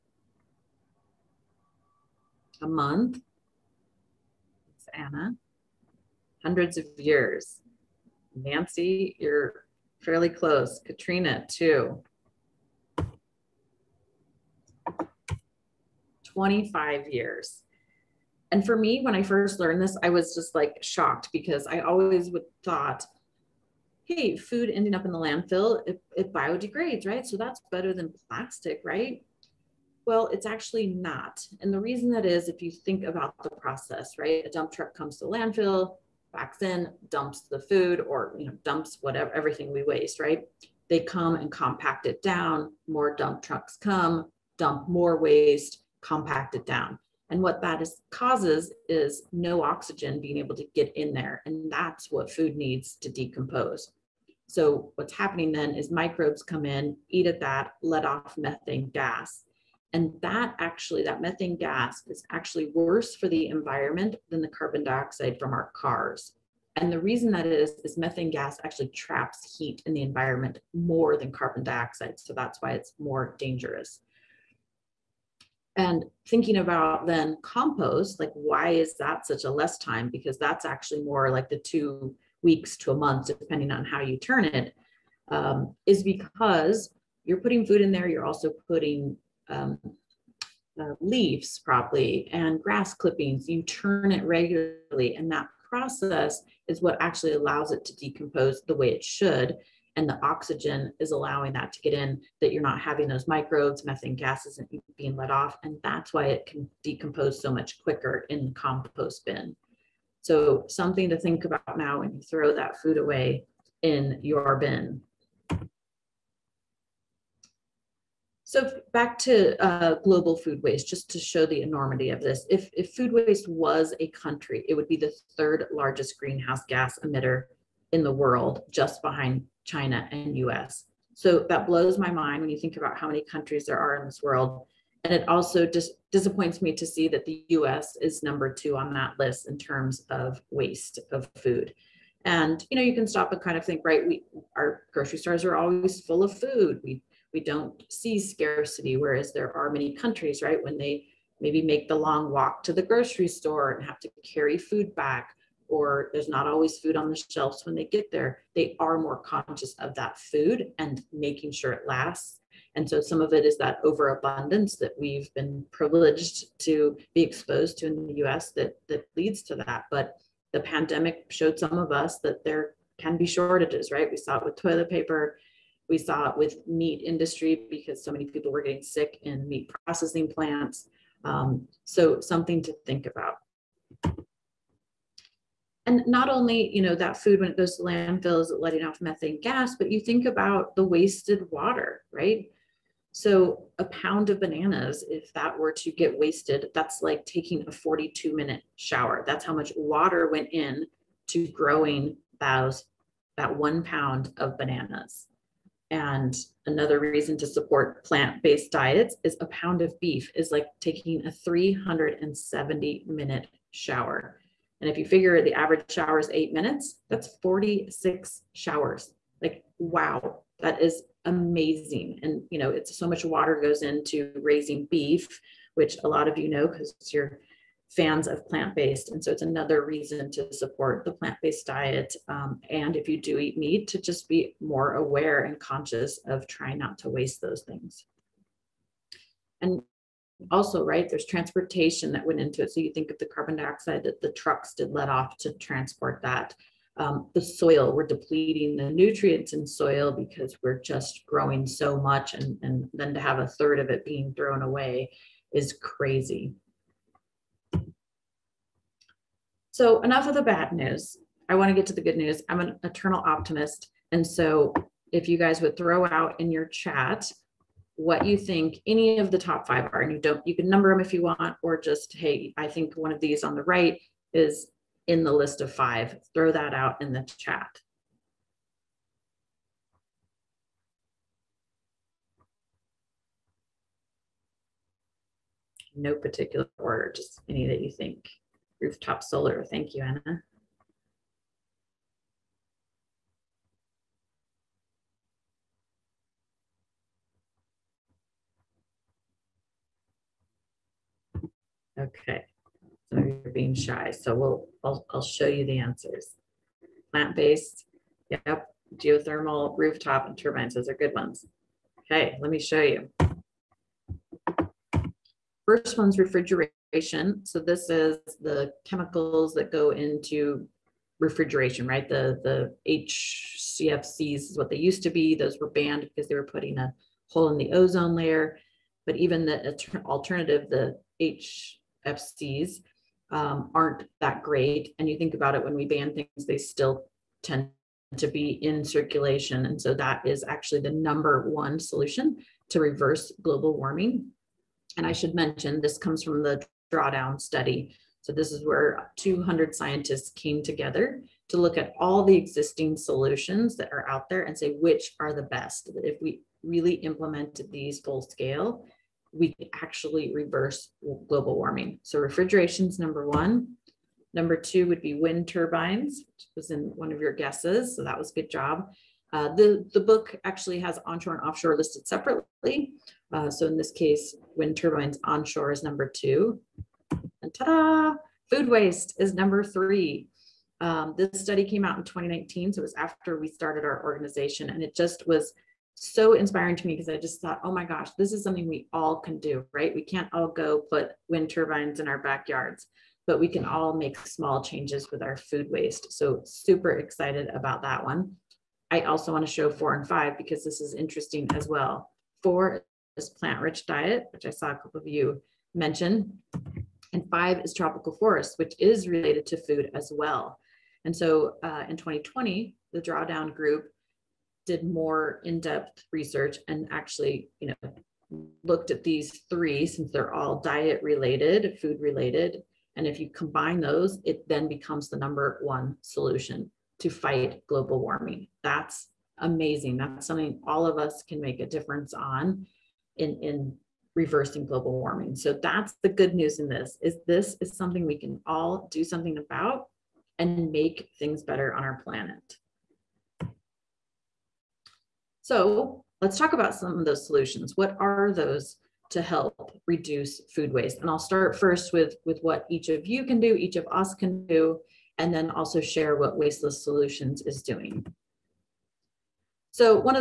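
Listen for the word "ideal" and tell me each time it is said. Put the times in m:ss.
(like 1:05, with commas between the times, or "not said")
not said.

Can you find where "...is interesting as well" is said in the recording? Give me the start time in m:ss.
6:40.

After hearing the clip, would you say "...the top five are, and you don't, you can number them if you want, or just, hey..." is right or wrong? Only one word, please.
right.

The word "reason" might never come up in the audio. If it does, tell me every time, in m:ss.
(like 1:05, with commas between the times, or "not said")
0:31, 1:06, 3:26, 3:49.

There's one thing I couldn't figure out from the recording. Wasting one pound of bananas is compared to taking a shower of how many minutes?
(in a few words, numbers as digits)
42 minutes.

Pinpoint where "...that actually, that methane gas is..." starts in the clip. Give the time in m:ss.
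1:00.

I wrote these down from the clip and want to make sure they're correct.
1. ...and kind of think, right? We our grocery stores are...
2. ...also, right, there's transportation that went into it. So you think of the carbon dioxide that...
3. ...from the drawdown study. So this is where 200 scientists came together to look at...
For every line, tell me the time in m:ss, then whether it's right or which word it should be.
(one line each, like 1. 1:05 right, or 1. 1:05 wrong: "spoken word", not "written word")
1. 2:23 right
2. 4:00 right
3. 5:46 right.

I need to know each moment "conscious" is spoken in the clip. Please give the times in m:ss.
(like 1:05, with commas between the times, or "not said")
2:39, 3:55.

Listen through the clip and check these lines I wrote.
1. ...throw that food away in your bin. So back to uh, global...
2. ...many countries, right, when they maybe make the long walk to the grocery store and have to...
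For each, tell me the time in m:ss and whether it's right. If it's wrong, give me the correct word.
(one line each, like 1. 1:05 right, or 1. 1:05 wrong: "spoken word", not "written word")
1. 1:52 right
2. 2:29 right.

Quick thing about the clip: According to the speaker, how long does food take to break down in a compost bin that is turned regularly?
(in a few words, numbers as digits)
2 weeks to a month.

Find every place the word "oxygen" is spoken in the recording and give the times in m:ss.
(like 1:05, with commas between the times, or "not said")
0:49, 1:40.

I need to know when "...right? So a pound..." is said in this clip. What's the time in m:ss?
3:12.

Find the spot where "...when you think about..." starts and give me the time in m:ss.
2:12.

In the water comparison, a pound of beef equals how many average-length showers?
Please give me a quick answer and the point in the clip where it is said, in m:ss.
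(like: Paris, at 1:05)
46, at 3:37.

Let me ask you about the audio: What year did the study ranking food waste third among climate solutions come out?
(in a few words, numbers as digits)
2019.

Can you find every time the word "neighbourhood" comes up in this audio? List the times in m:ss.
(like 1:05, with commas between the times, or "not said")
not said.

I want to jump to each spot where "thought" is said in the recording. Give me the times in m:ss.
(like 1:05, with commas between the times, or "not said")
0:22, 6:27.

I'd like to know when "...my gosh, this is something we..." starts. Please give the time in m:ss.
6:27.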